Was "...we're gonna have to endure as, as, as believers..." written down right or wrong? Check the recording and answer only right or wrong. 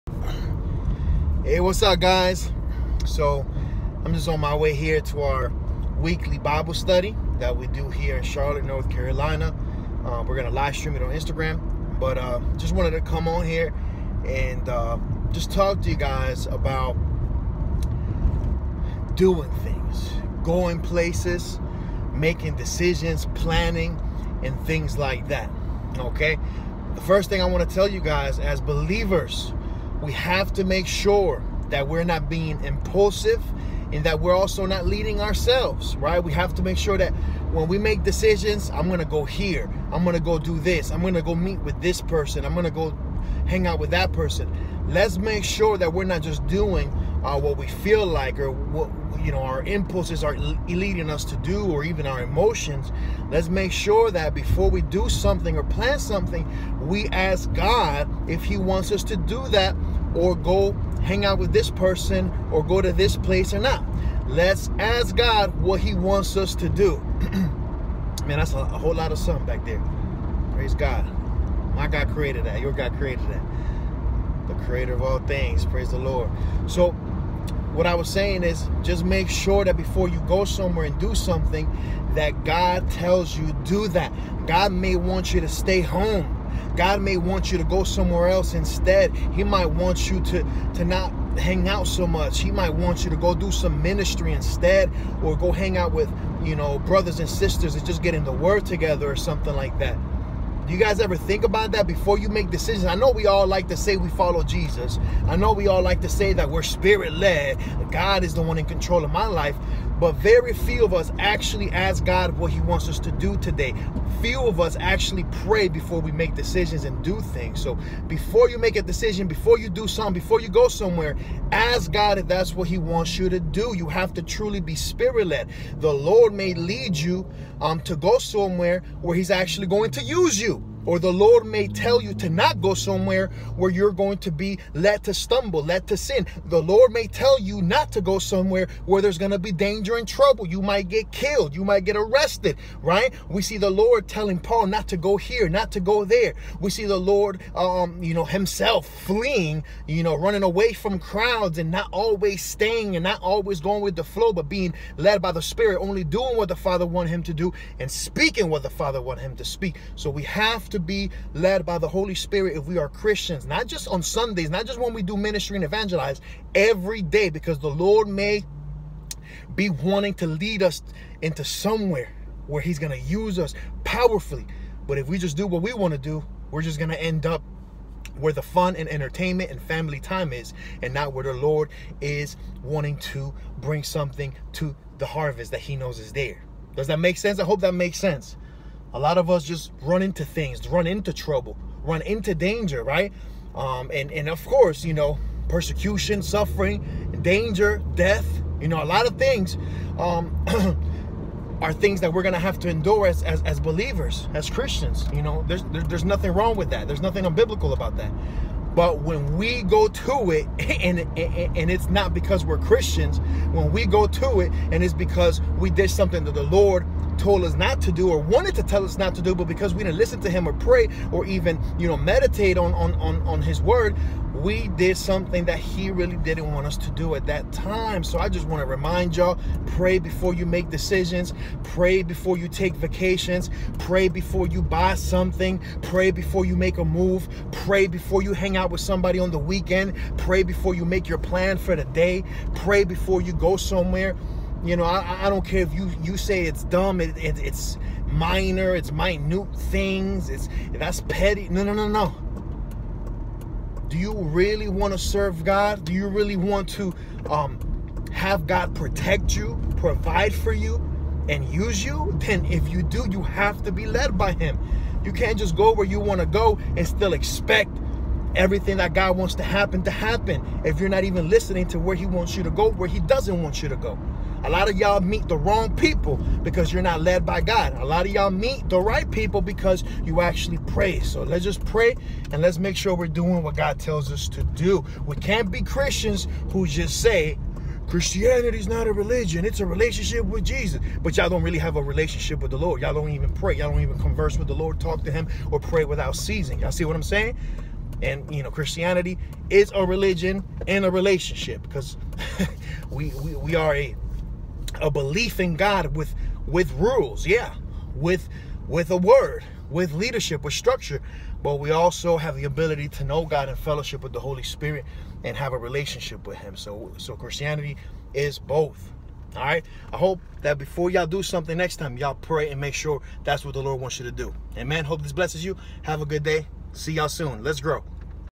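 right.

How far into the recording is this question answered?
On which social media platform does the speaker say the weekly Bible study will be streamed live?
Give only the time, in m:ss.
0:11.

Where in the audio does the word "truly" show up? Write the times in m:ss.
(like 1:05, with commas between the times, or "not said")
2:04.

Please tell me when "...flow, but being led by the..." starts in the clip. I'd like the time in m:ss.
2:34.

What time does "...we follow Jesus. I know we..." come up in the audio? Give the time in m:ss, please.
1:43.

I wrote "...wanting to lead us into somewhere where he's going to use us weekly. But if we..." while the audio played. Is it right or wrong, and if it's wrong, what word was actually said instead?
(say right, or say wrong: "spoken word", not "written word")
wrong: "powerfully", not "weekly".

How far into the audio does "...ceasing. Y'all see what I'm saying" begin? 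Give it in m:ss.
4:56.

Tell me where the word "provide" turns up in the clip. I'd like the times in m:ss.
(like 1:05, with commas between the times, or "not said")
4:19.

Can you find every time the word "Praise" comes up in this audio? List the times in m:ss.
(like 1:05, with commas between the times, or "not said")
1:10, 1:15.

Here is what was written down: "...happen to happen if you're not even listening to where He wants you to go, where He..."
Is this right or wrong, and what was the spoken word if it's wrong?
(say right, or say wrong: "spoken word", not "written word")
right.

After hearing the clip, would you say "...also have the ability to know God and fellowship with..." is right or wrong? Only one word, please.
right.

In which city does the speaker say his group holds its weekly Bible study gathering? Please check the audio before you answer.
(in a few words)
Charlotte, North Carolina.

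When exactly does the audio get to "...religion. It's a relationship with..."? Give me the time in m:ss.
4:48.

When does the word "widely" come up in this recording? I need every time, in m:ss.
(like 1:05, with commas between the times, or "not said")
not said.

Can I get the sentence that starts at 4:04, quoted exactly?
You know, I, I don't care if you you say it's dumb.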